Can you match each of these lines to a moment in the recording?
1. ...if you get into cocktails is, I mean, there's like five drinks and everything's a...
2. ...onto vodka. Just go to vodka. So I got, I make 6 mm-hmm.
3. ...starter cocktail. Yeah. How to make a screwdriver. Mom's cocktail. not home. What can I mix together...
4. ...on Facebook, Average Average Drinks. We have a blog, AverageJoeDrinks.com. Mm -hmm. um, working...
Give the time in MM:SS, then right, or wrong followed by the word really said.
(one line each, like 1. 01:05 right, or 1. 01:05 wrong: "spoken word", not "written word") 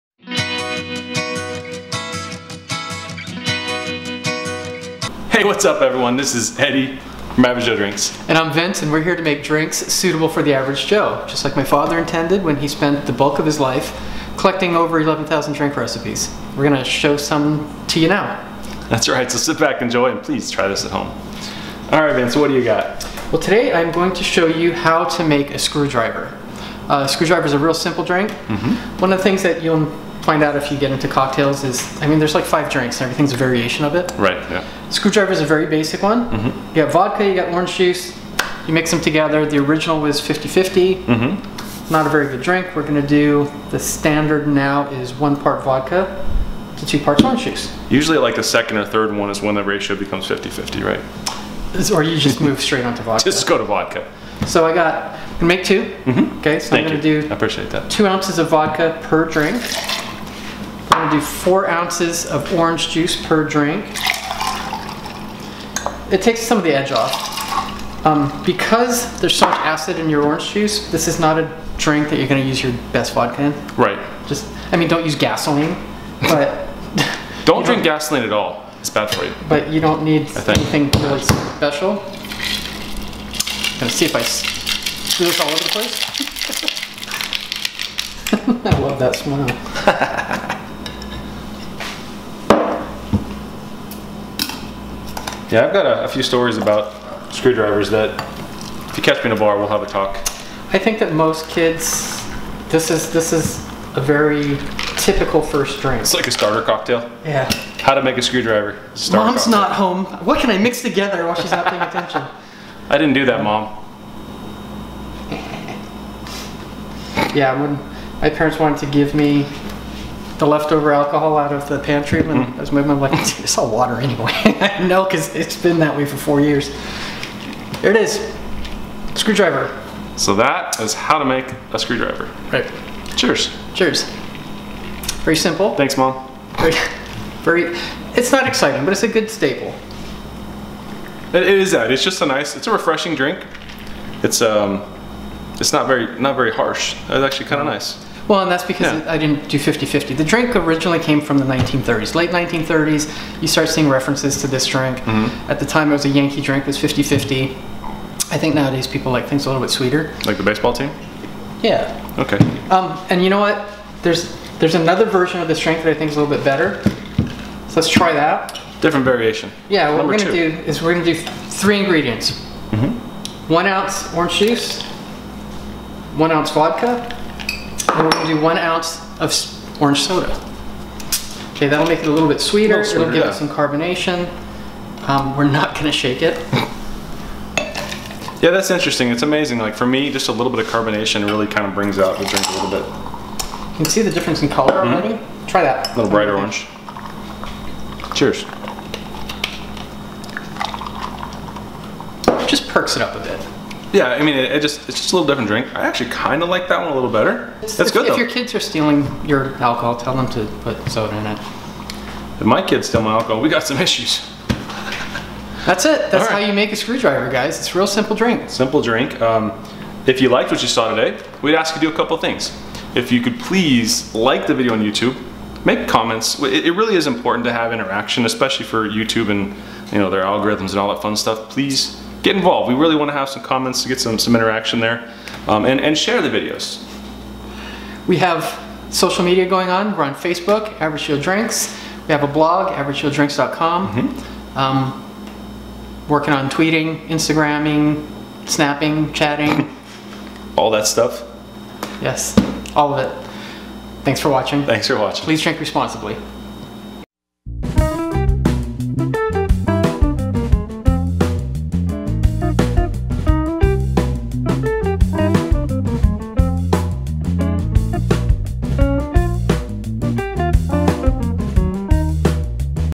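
1. 00:30 right
2. 00:52 wrong: "2", not "6"
3. 01:46 right
4. 04:00 wrong: "Joe", not "Average".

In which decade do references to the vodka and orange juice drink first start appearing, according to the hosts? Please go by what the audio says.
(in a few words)
1930s.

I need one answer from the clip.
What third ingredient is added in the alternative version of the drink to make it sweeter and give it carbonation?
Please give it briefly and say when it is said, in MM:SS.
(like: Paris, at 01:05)
orange soda, at 02:59.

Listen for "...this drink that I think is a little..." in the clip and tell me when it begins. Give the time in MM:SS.
02:45.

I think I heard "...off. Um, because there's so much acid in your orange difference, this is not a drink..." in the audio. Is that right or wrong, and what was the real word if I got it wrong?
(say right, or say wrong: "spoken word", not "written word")
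wrong: "juice", not "difference".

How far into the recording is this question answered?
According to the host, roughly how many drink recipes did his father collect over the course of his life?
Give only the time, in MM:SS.
00:14.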